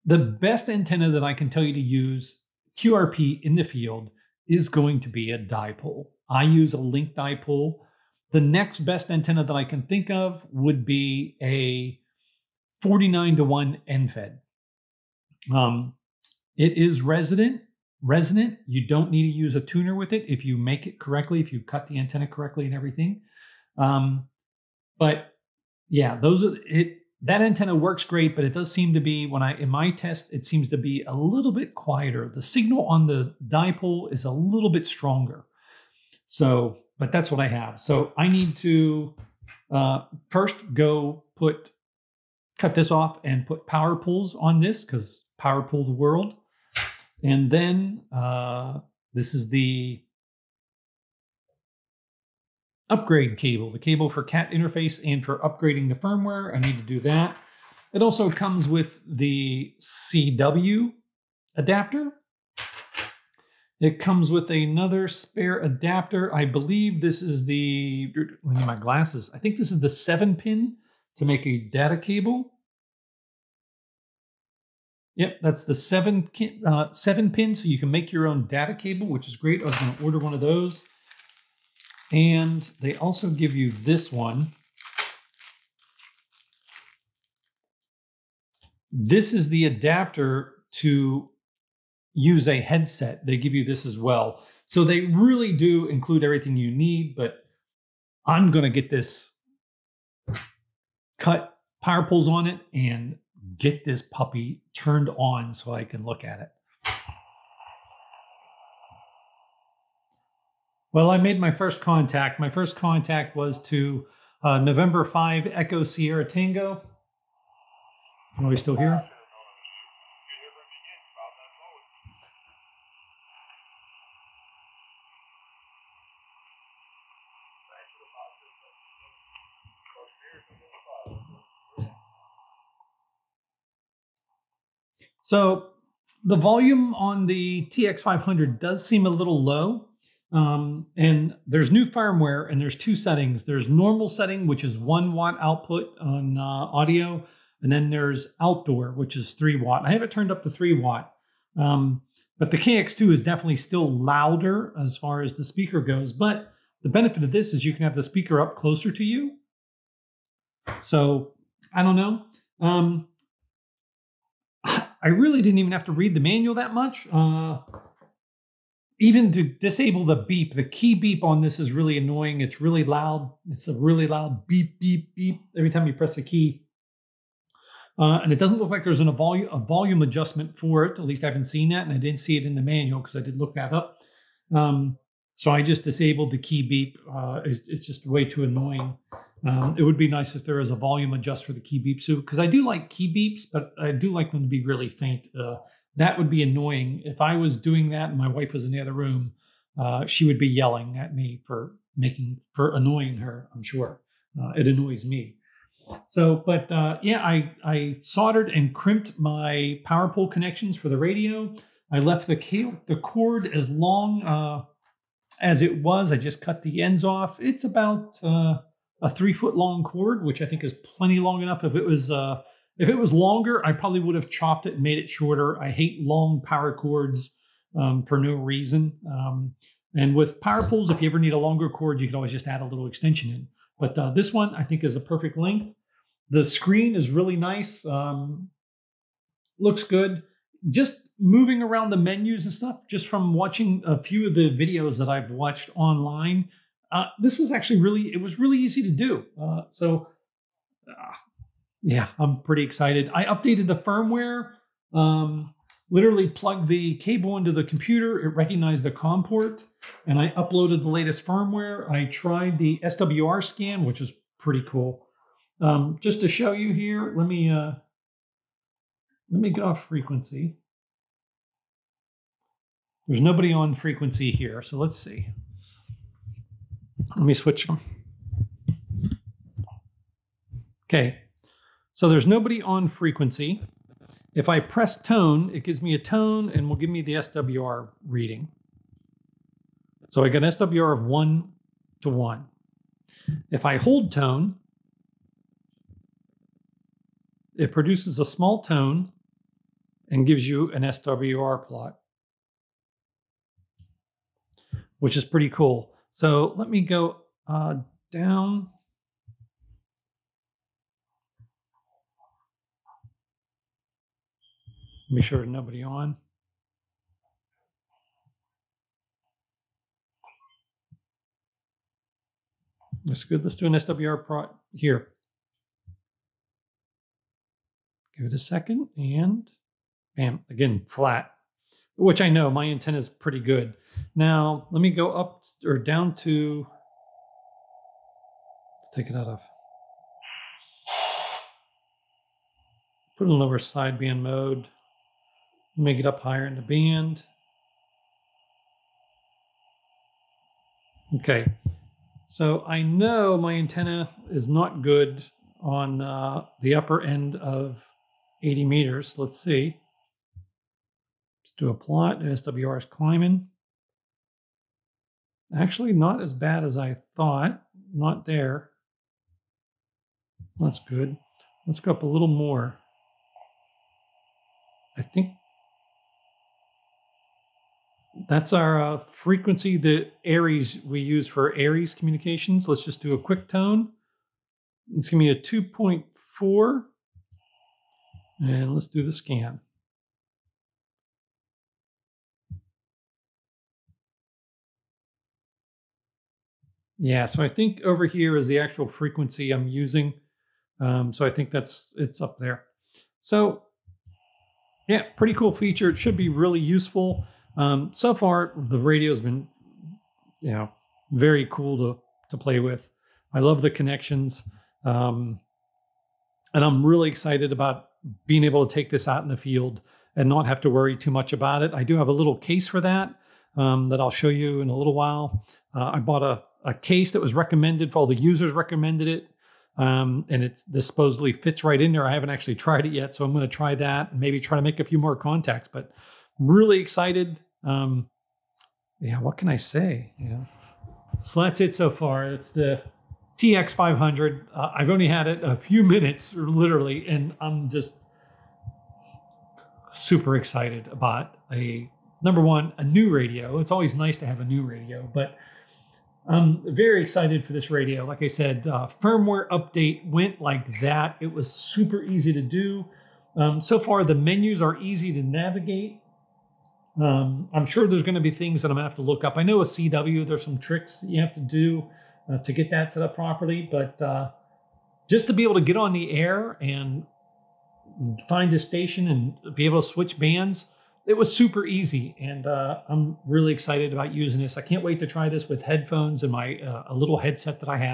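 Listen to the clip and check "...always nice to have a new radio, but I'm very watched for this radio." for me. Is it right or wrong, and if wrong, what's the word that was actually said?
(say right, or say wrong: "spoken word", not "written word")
wrong: "excited", not "watched".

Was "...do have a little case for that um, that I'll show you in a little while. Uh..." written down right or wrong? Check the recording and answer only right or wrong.
right.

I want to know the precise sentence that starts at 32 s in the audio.
The signal on the dipole is a little bit stronger.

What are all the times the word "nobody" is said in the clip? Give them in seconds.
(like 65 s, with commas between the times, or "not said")
273 s, 282 s, 315 s.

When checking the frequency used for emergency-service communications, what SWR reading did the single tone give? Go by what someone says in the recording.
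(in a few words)
2.4.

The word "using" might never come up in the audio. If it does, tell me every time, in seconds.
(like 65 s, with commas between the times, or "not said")
399 s, 484 s.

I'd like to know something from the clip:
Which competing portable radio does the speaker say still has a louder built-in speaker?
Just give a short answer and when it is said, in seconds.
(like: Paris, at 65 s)
KX2, at 152 s.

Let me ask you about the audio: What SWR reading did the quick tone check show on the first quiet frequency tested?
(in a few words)
1 to 1.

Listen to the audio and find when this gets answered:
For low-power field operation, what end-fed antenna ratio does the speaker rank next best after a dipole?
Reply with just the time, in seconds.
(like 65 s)
12 s.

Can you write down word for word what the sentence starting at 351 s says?
Okay, so I know my antenna is not good on uh, the upper end of 80 meters.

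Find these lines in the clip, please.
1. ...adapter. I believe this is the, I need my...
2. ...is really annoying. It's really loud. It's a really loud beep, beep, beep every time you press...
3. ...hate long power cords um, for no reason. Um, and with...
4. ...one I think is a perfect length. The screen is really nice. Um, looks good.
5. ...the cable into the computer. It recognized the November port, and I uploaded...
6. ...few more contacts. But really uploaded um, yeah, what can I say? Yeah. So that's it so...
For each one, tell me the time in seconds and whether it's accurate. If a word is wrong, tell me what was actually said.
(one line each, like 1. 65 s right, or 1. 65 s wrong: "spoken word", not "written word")
1. 65 s right
2. 171 s right
3. 225 s right
4. 234 s right
5. 256 s wrong: "COM", not "November"
6. 434 s wrong: "excited", not "uploaded".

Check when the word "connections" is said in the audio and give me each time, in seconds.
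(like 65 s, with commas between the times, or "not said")
210 s, 413 s.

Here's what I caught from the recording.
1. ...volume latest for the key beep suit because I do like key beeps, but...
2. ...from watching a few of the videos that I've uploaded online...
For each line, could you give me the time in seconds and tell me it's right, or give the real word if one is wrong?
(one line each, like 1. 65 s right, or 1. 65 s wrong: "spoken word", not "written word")
1. 190 s wrong: "adjust", not "latest"
2. 243 s wrong: "watched", not "uploaded".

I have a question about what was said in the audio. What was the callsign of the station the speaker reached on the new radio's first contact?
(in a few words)
N5EST.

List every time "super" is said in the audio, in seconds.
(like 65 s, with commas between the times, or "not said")
449 s, 461 s, 481 s.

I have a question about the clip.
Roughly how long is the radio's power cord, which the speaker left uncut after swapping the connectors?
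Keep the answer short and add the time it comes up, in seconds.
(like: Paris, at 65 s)
3 feet, at 219 s.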